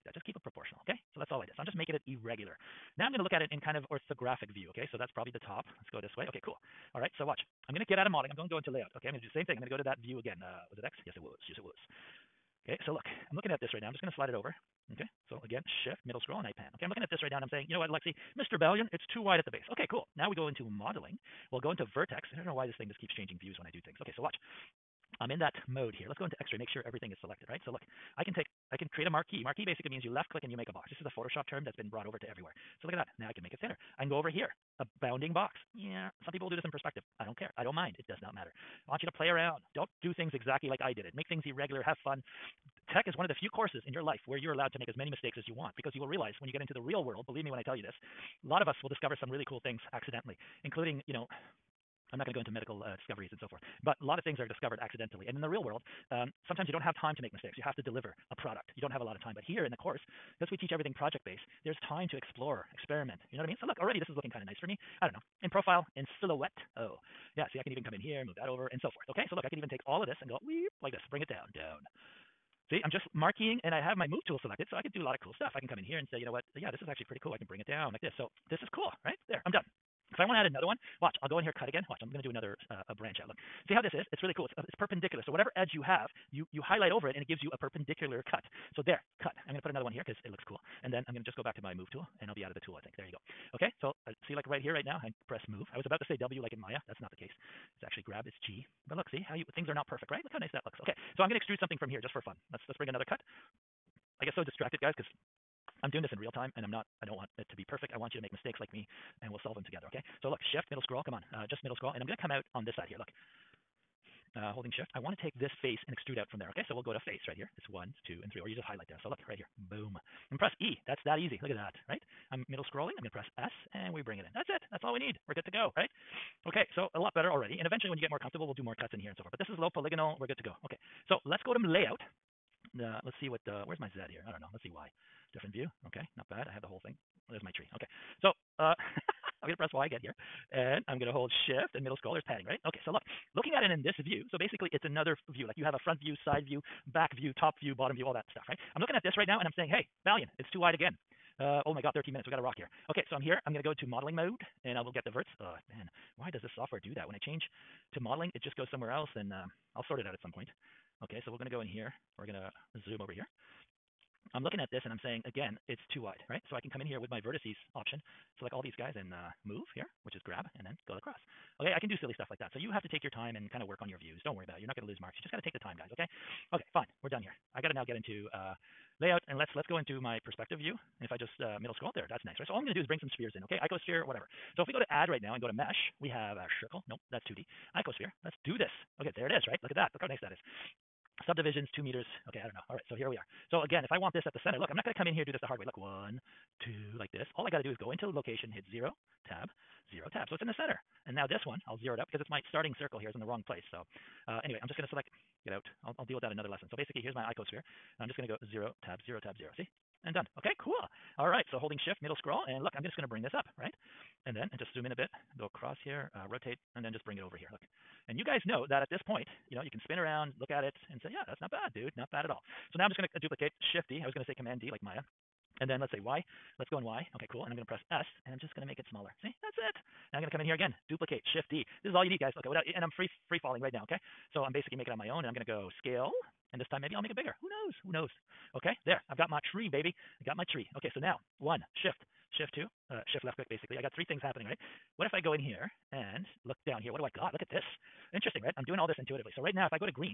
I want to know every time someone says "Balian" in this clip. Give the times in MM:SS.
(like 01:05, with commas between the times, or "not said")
00:18, 02:30.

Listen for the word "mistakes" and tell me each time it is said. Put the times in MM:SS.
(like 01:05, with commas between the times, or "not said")
00:45, 00:57, 01:48.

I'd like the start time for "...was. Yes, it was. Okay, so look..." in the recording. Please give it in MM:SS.
00:11.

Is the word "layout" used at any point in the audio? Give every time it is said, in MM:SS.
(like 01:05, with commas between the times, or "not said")
00:08, 02:11, 02:59.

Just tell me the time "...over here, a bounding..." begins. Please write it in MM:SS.
00:34.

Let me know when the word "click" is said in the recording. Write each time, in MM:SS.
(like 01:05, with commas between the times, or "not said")
00:30, 04:03.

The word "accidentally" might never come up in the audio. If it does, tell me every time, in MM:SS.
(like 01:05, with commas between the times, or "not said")
00:49, 00:54.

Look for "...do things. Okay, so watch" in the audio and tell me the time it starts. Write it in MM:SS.
00:23.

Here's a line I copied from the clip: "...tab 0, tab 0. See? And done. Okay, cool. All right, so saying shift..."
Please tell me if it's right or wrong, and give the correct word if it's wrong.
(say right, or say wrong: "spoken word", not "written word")
wrong: "holding", not "saying".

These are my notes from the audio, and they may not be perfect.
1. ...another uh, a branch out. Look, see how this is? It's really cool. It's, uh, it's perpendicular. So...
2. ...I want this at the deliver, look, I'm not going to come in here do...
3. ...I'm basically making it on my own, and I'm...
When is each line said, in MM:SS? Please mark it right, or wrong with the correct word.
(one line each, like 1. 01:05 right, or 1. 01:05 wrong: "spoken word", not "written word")
1. 01:22 right
2. 03:13 wrong: "center", not "deliver"
3. 03:54 right.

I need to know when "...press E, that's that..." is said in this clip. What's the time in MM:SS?
02:00.